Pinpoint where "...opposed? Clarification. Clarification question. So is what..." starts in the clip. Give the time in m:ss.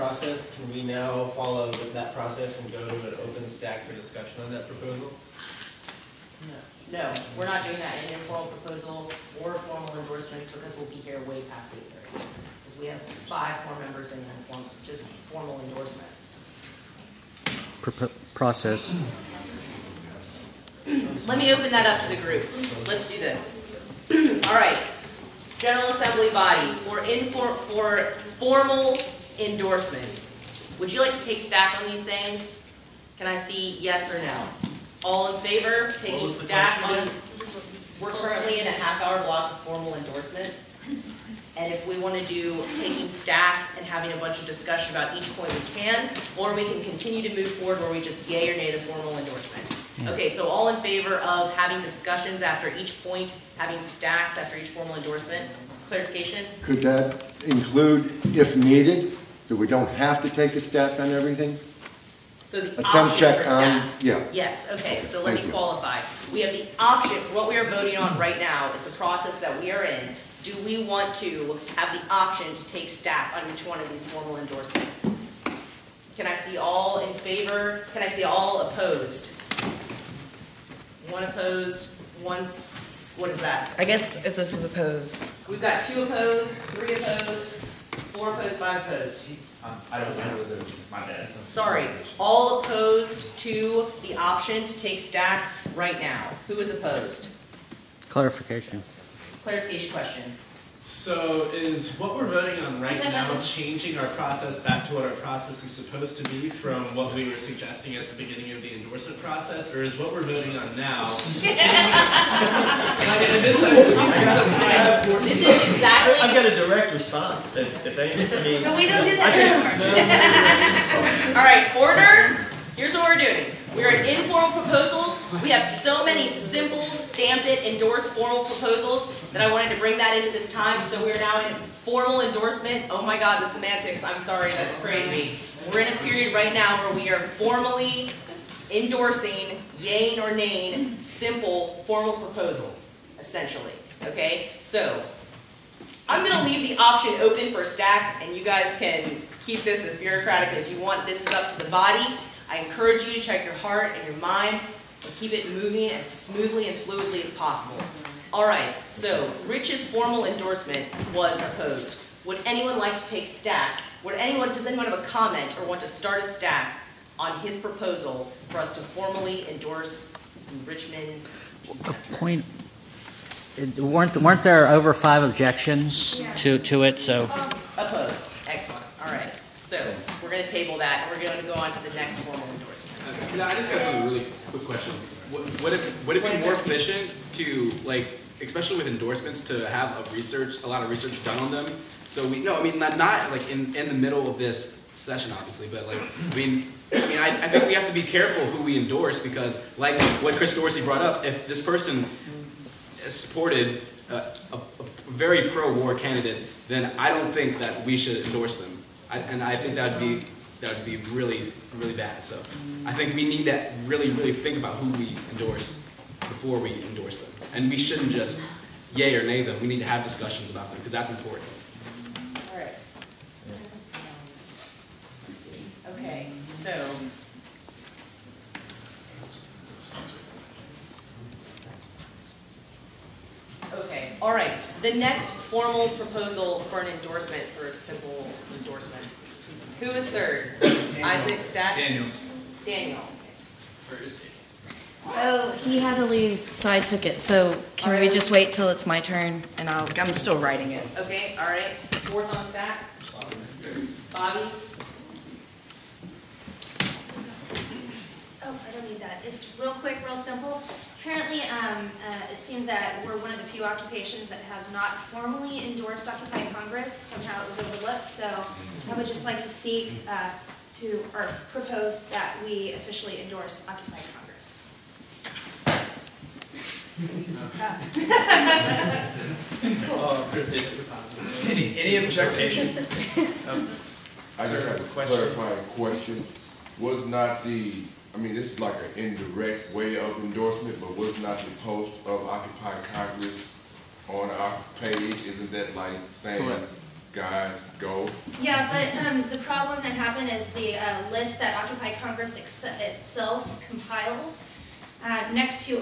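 1:36.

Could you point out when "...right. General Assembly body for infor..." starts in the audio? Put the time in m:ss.
0:24.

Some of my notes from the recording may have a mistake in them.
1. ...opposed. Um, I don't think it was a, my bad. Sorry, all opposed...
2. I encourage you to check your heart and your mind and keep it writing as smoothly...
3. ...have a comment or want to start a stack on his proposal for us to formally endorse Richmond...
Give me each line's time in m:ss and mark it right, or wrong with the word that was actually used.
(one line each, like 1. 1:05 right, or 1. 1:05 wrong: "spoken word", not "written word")
1. 1:28 right
2. 2:32 wrong: "moving", not "writing"
3. 2:44 right.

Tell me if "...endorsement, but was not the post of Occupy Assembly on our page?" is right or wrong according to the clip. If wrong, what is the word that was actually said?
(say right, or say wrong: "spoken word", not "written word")
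wrong: "Congress", not "Assembly".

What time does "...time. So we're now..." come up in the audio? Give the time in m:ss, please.
2:10.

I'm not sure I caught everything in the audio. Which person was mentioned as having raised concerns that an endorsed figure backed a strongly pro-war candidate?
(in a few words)
Chris Dorsey.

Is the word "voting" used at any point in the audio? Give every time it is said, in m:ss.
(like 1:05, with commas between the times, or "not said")
1:07, 1:42, 1:50.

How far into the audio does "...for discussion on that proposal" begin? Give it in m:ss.
0:03.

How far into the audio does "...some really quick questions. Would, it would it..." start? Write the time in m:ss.
3:03.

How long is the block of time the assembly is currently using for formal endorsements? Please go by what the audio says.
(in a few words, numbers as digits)
half hour.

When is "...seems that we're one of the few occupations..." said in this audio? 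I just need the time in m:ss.
4:22.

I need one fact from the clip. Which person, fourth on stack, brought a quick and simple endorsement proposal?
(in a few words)
Bobby.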